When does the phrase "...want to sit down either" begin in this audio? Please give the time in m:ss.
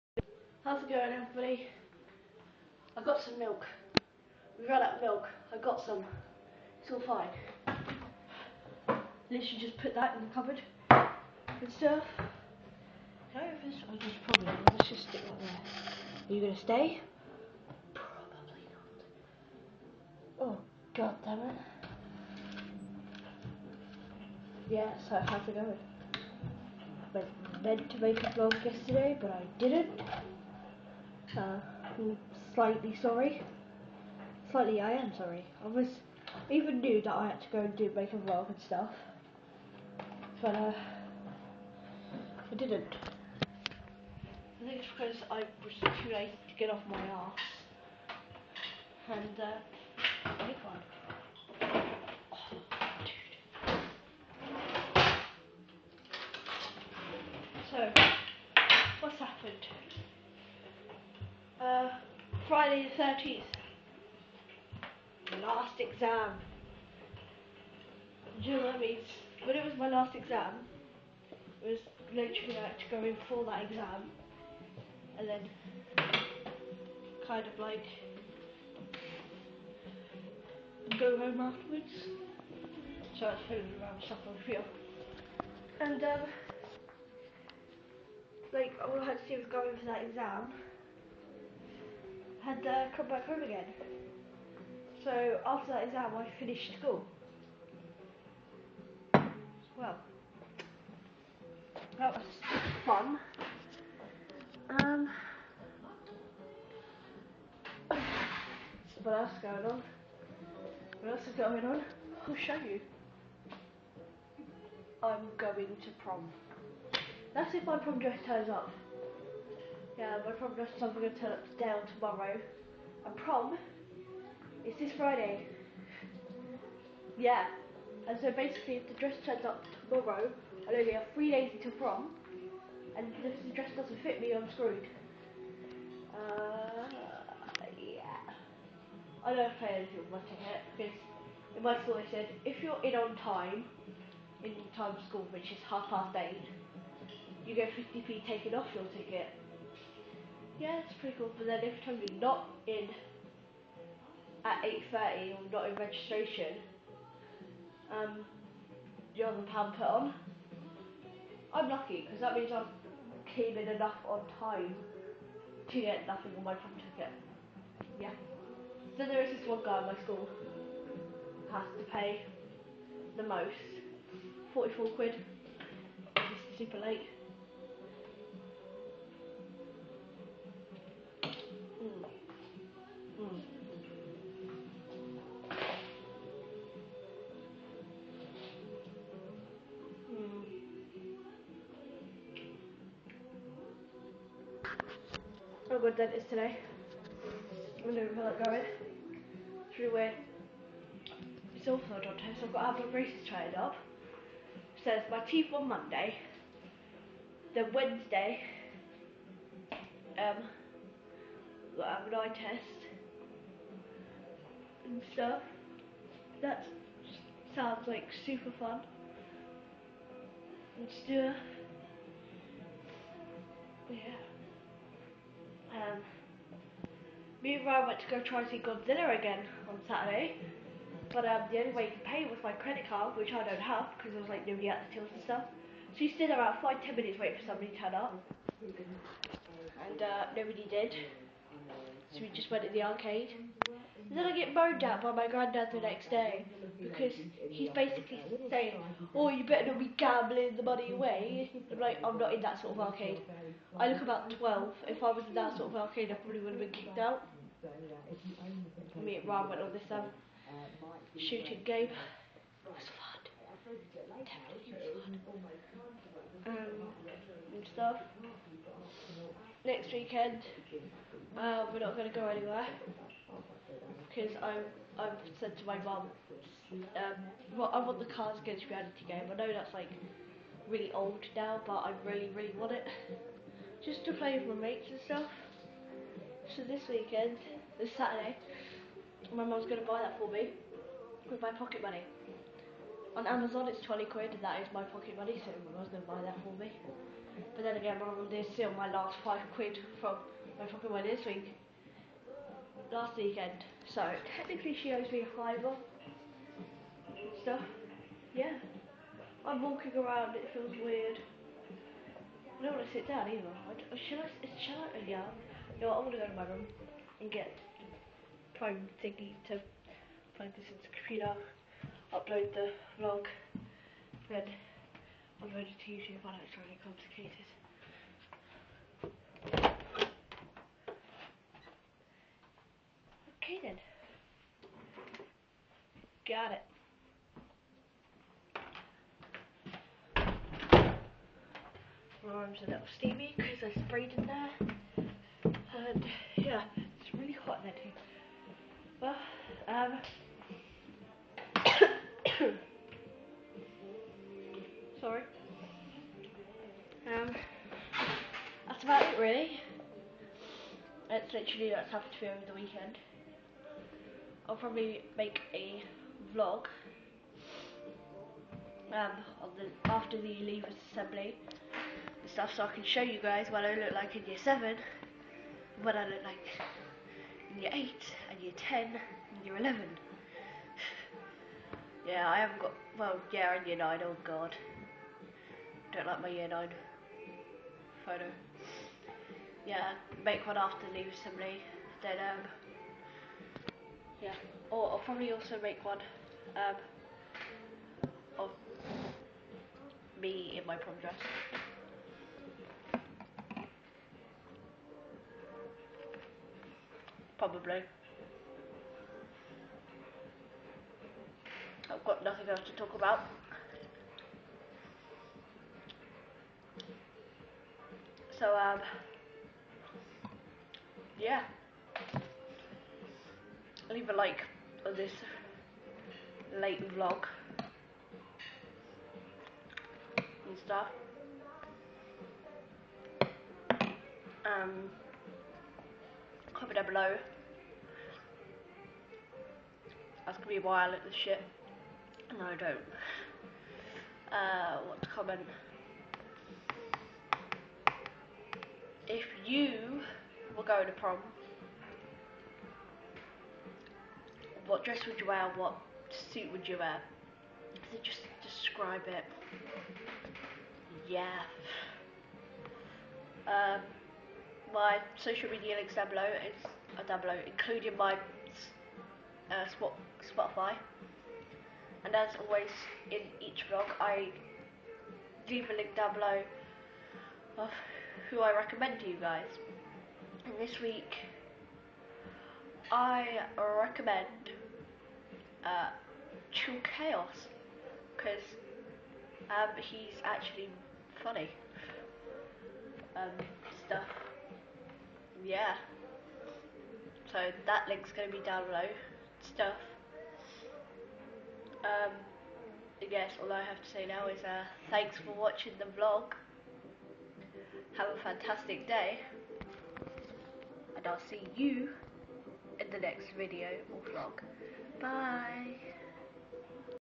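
5:12.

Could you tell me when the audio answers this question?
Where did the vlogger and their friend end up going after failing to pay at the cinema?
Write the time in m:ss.
4:02.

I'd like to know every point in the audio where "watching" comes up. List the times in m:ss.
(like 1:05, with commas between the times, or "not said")
2:20, 8:25.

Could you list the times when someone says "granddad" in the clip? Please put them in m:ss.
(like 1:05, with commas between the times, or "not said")
4:05.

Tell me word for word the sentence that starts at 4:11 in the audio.
I'm like, I'm not in that sort of arcade.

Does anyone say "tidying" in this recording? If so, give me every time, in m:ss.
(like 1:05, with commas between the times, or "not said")
not said.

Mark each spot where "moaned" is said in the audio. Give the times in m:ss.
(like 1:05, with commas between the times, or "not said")
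4:04.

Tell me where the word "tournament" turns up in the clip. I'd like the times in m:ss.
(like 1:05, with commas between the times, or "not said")
not said.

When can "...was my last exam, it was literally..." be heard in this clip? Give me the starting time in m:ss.
1:09.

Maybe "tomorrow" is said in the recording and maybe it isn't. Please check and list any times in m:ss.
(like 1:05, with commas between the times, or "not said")
2:01, 2:09.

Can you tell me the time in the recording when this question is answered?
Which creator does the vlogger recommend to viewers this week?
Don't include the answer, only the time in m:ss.
8:06.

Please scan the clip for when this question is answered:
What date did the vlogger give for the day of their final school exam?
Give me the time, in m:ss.
1:02.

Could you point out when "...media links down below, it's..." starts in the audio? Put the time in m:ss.
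7:45.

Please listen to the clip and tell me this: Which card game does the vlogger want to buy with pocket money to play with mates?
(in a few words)
Cards Against Reality.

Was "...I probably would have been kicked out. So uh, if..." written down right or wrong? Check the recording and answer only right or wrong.
right.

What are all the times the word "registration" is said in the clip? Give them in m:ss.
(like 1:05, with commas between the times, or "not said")
2:35.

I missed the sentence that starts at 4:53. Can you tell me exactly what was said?
On Amazon it's 20 quid and that is my pocket money, so my mum's going to buy that for me.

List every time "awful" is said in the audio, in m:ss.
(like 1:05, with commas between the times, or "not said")
3:21.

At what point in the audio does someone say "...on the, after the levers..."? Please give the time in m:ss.
6:09.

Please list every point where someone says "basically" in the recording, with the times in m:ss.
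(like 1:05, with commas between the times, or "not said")
2:08, 4:07.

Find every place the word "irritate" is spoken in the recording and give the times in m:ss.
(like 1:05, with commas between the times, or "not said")
not said.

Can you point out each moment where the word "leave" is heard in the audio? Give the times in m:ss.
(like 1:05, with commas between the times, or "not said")
6:30, 7:03, 7:55.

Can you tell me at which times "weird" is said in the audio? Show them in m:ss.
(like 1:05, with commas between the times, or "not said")
3:19, 5:10.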